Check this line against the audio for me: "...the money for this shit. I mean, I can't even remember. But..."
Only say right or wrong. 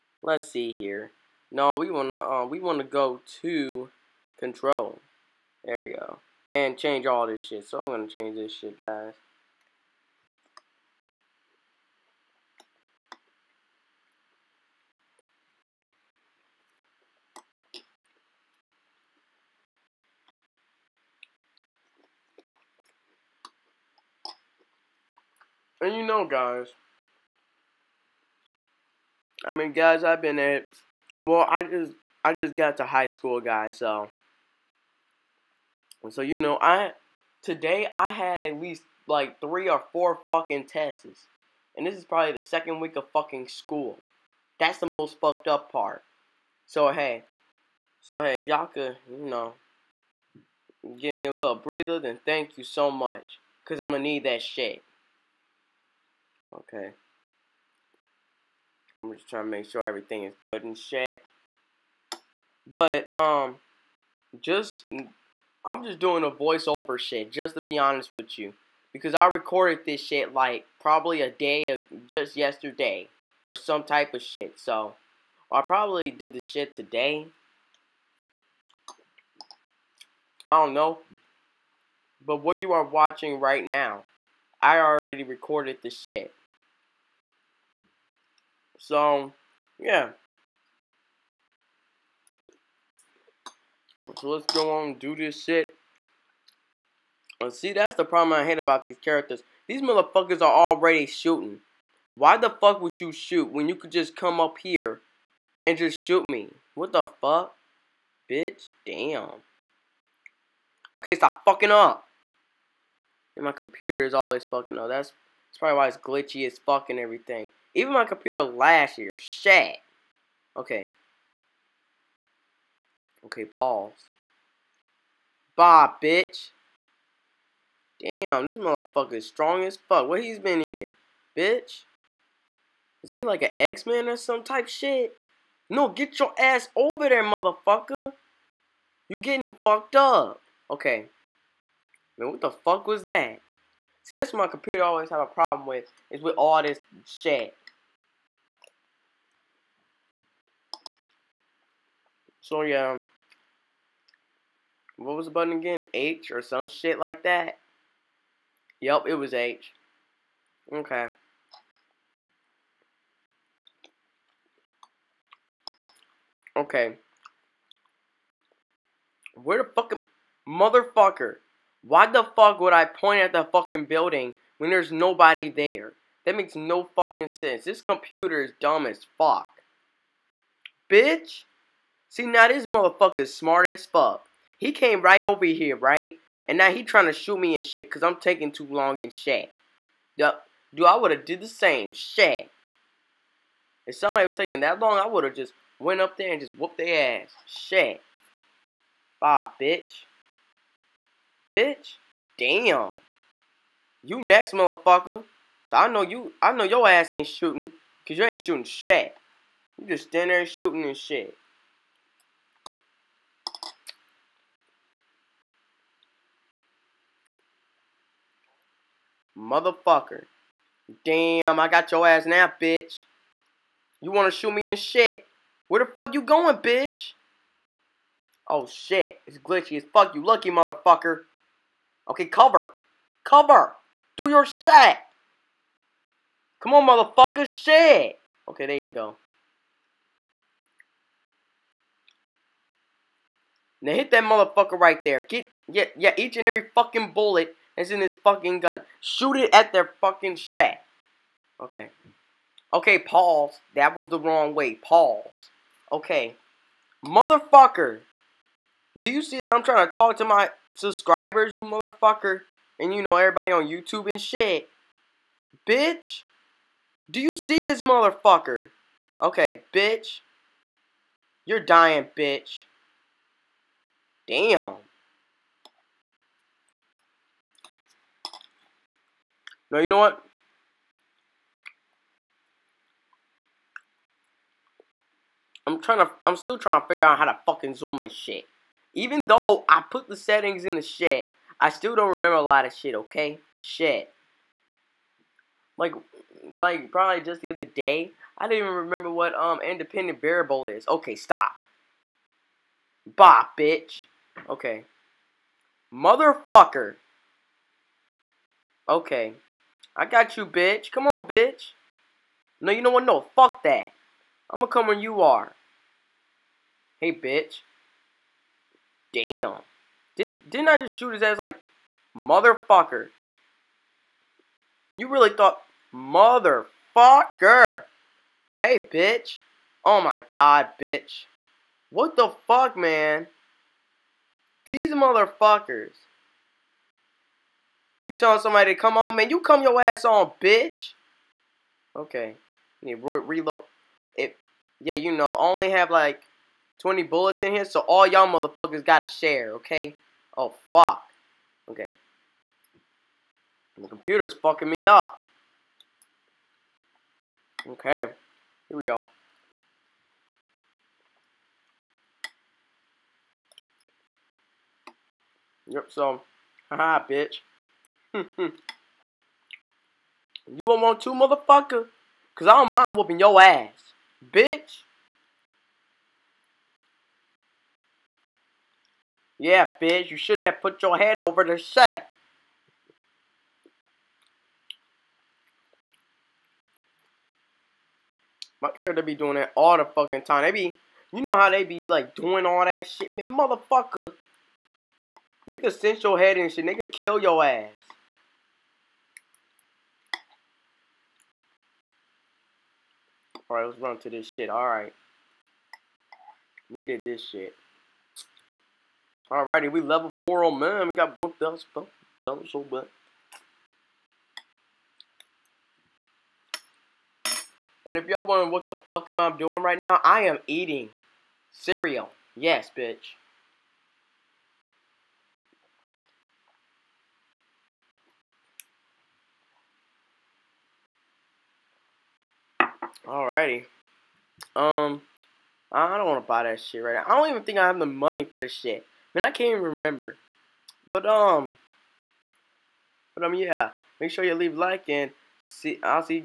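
right.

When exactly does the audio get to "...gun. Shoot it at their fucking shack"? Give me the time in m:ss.
4:08.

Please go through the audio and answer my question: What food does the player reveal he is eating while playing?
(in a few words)
cereal.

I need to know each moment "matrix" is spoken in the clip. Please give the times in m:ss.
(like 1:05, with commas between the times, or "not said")
not said.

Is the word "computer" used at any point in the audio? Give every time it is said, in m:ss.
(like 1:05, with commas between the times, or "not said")
1:53, 1:58, 2:24, 2:57, 5:53.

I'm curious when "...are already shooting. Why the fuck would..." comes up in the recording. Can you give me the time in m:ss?
1:40.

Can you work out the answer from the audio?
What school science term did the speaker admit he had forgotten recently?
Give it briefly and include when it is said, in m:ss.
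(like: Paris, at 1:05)
independent variable, at 4:59.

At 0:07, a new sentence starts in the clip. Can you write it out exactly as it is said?
So I'm gonna change this shit, guys.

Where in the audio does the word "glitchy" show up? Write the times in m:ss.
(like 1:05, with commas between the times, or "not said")
1:55, 3:49.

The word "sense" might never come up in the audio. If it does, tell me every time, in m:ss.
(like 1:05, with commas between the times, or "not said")
2:57.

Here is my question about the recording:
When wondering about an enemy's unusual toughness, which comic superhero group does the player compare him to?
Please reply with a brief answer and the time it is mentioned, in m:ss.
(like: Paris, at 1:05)
X-Man, at 2:13.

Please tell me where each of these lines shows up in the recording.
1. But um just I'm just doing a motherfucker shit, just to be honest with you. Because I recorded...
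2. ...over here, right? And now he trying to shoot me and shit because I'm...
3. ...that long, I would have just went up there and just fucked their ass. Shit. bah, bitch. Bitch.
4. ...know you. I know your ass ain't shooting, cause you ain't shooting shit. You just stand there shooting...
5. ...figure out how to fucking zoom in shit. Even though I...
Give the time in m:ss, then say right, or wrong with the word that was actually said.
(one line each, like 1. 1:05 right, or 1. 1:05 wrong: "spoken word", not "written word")
1. 1:02 wrong: "voiceover", not "motherfucker"
2. 3:05 right
3. 3:14 wrong: "whooped", not "fucked"
4. 3:25 right
5. 4:46 right.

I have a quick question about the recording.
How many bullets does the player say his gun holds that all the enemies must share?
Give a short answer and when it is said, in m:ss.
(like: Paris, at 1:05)
20, at 5:46.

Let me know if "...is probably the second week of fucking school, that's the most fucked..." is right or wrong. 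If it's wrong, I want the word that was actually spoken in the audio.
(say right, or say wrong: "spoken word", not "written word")
right.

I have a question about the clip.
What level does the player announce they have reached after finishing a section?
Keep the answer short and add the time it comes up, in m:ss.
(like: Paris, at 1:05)
level 4, at 6:49.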